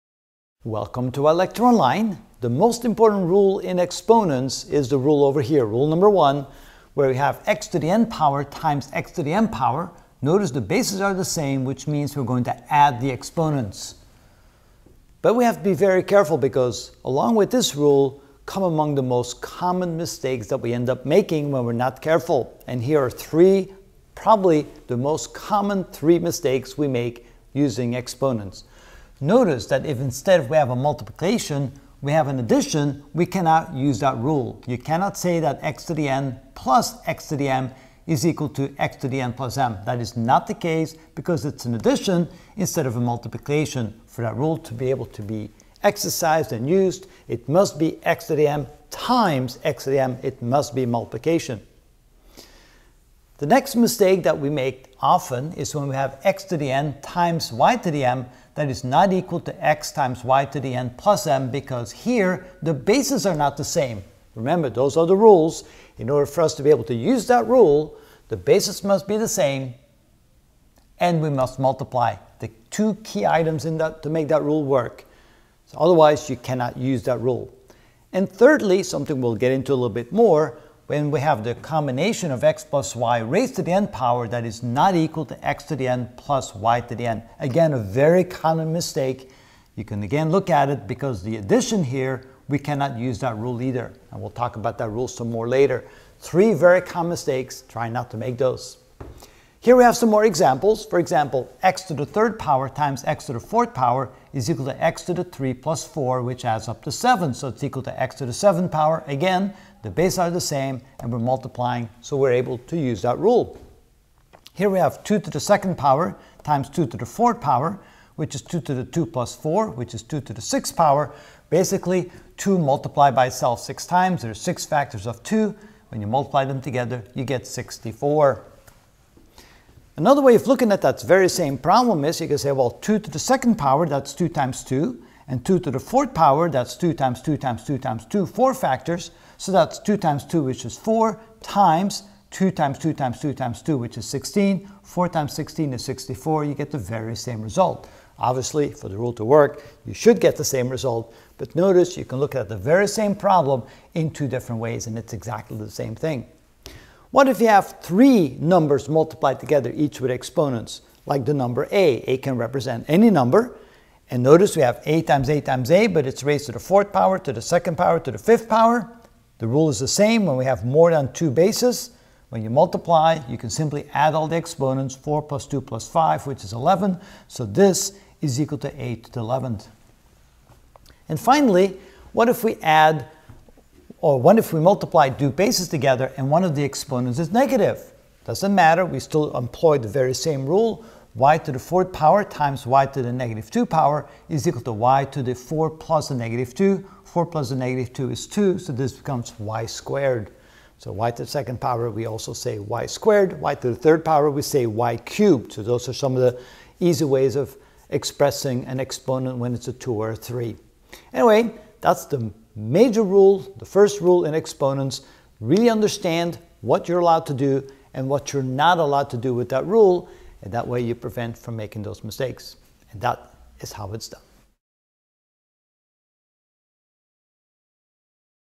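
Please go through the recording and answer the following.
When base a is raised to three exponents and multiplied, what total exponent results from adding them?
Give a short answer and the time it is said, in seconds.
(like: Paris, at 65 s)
11, at 176 s.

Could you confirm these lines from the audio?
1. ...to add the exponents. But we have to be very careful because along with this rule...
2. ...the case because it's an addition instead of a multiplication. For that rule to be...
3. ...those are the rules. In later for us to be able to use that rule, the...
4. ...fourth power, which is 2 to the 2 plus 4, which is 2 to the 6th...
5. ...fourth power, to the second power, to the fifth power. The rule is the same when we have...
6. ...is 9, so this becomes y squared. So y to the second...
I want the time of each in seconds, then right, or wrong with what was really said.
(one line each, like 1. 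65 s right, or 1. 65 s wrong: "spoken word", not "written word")
1. 12 s right
2. 40 s right
3. 64 s wrong: "order", not "later"
4. 117 s right
5. 166 s right
6. 198 s wrong: "2", not "9".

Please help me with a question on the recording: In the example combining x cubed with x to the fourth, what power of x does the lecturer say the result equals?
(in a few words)
7th power.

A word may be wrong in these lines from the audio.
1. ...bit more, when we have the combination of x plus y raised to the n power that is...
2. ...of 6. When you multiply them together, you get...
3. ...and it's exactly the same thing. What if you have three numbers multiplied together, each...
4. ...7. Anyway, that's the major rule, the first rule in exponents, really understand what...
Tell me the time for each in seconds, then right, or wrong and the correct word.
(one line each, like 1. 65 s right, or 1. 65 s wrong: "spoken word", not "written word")
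1. 79 s right
2. 125 s wrong: "2", not "6"
3. 154 s right
4. 210 s wrong: "3", not "7".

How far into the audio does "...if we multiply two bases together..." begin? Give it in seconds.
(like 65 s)
184 s.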